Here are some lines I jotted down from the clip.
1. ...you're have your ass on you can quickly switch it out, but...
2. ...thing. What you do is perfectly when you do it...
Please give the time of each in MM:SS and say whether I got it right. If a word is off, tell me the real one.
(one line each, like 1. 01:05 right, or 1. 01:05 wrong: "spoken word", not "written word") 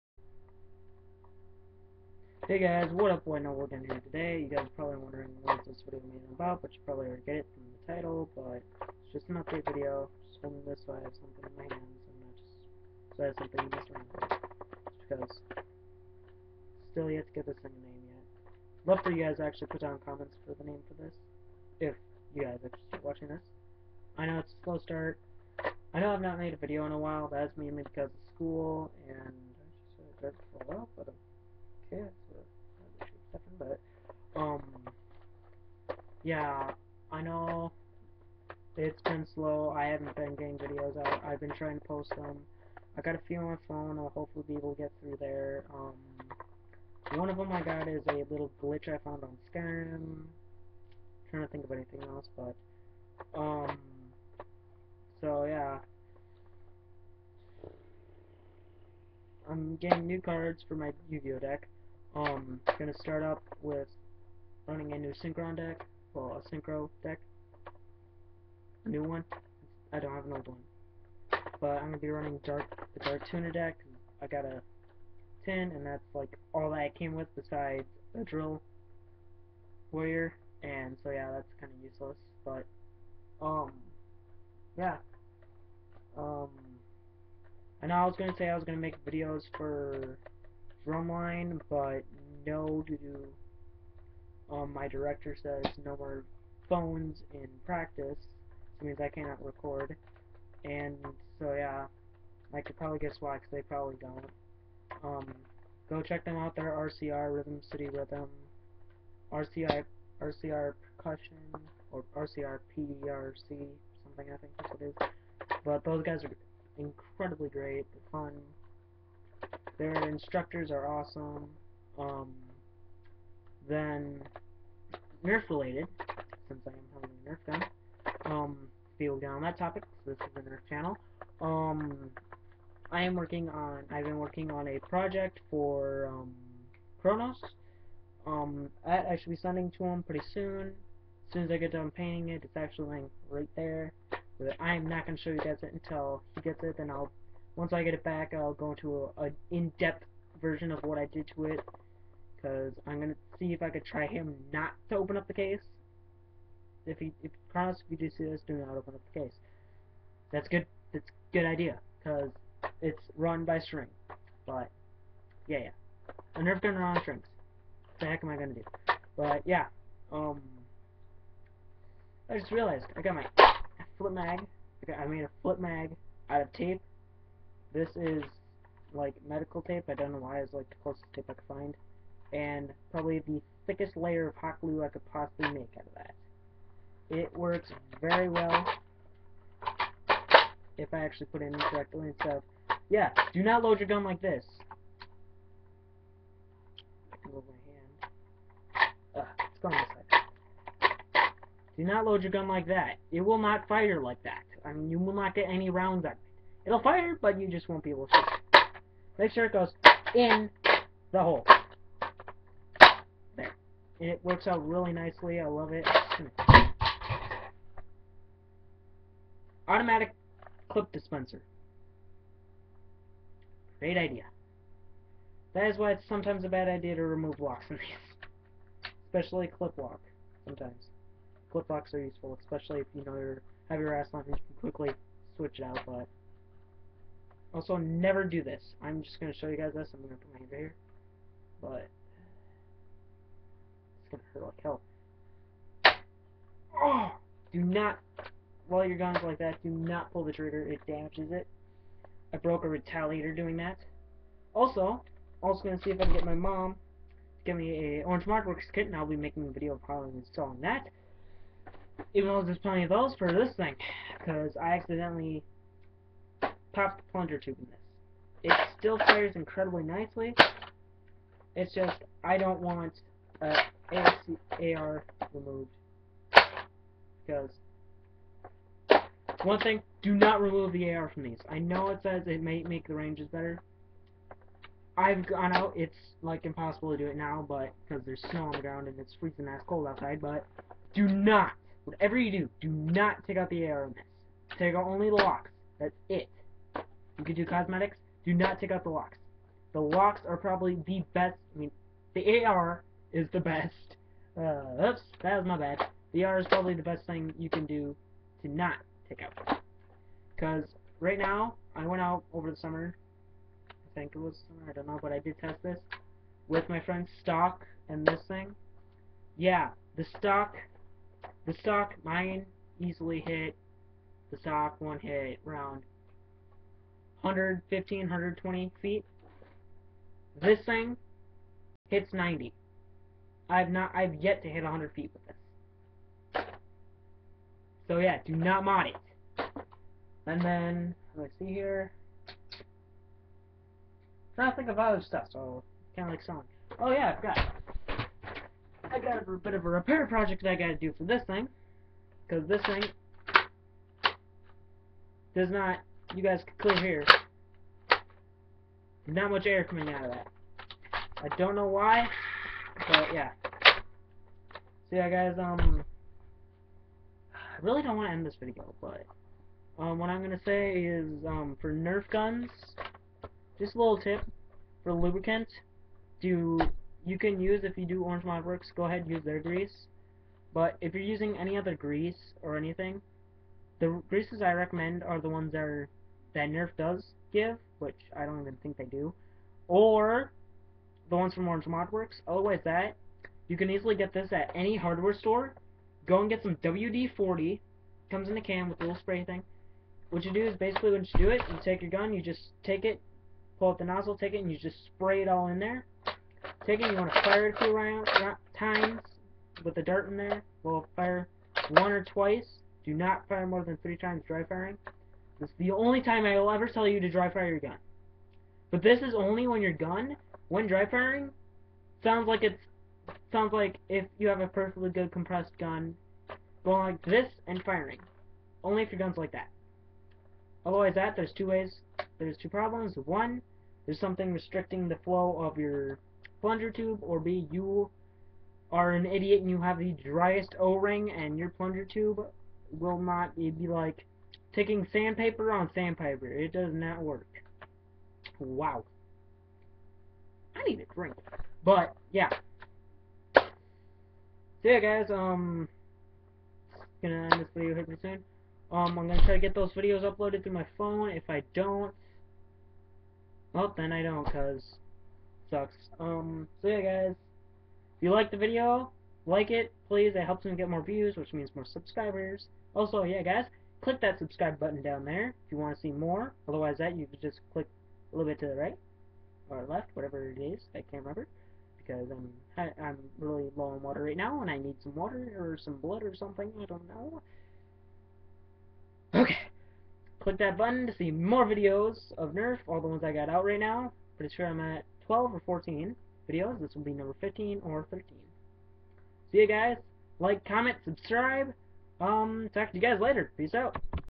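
1. 03:53 right
2. 06:39 wrong: "basically", not "perfectly".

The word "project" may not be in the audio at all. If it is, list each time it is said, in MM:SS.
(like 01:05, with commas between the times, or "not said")
02:14, 05:50.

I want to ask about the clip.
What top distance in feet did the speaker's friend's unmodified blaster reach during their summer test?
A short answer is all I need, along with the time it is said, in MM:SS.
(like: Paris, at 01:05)
120 feet, at 05:27.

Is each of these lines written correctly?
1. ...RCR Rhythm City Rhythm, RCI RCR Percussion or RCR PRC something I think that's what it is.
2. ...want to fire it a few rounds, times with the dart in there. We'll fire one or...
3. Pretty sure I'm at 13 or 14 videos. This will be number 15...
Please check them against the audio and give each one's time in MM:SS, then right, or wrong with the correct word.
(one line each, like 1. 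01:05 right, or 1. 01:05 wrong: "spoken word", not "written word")
1. 01:46 right
2. 06:46 right
3. 08:14 wrong: "12", not "13".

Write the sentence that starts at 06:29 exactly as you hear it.
Or the ones from Orange Modworks.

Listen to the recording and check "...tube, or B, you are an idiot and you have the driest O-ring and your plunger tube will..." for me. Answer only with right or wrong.
right.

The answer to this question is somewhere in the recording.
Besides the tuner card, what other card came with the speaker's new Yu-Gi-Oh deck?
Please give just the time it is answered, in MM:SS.
01:18.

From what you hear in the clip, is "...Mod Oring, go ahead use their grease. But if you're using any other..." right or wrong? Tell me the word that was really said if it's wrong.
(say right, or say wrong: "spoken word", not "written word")
wrong: "Works", not "Oring".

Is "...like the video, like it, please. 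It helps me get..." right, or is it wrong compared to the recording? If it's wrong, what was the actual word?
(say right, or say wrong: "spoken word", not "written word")
right.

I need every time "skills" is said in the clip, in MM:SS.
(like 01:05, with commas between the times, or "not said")
not said.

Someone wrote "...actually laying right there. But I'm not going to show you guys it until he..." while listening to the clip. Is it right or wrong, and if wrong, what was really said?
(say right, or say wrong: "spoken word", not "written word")
right.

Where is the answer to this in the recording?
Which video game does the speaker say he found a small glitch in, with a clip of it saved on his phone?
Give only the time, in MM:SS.
00:49.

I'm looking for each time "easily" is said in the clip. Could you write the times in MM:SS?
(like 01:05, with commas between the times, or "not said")
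05:22, 06:33.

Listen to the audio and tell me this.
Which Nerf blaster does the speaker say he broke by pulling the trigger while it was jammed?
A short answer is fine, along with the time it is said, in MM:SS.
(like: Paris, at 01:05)
Retaliator, at 04:12.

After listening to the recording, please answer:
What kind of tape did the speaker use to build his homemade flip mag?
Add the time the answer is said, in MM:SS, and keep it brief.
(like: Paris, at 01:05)
Medical tape, at 02:59.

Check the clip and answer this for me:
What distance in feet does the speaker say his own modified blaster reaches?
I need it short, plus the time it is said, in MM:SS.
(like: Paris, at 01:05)
90, at 05:32.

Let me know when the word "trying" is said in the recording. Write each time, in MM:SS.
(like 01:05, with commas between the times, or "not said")
00:41, 00:51, 05:44.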